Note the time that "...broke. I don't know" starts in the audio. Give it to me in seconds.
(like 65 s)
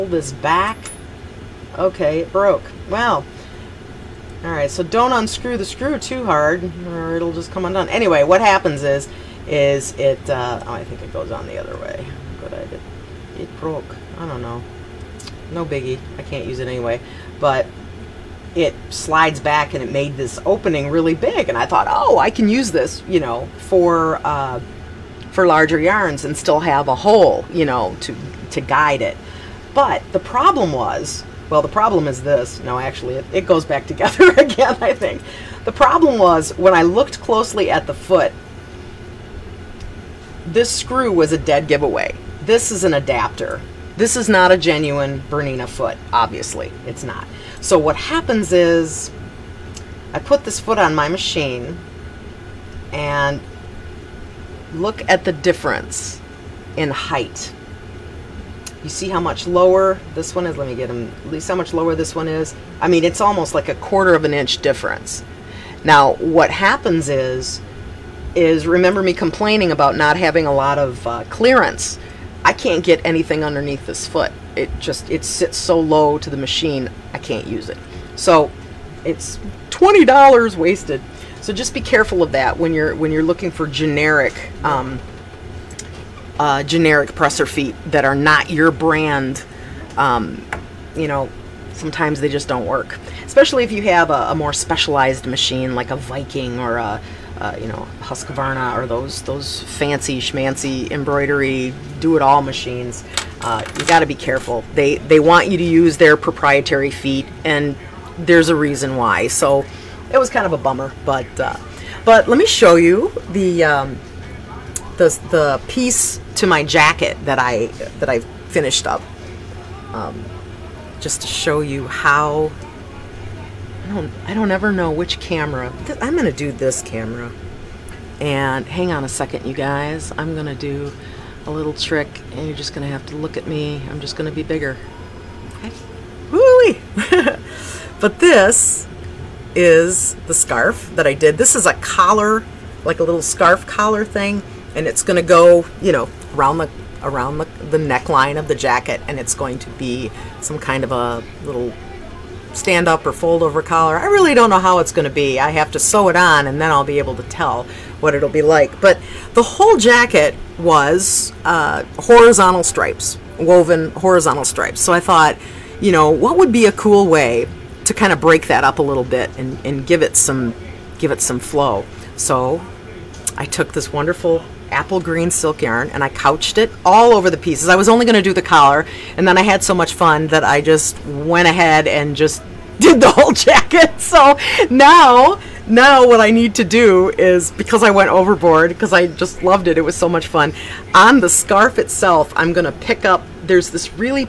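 13 s.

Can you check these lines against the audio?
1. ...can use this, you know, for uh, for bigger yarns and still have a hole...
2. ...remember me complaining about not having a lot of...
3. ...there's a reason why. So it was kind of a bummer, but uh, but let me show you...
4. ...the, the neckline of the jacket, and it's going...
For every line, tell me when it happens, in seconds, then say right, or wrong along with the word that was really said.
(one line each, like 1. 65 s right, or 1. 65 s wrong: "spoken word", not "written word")
1. 22 s wrong: "larger", not "bigger"
2. 68 s right
3. 108 s right
4. 147 s right.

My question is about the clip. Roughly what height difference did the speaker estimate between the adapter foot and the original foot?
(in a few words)
a quarter of an inch.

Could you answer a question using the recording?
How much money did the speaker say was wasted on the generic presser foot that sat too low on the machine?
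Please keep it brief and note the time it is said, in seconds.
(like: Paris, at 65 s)
$20, at 79 s.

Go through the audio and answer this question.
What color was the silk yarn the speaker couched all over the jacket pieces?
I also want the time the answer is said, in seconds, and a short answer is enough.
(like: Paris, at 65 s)
apple green, at 174 s.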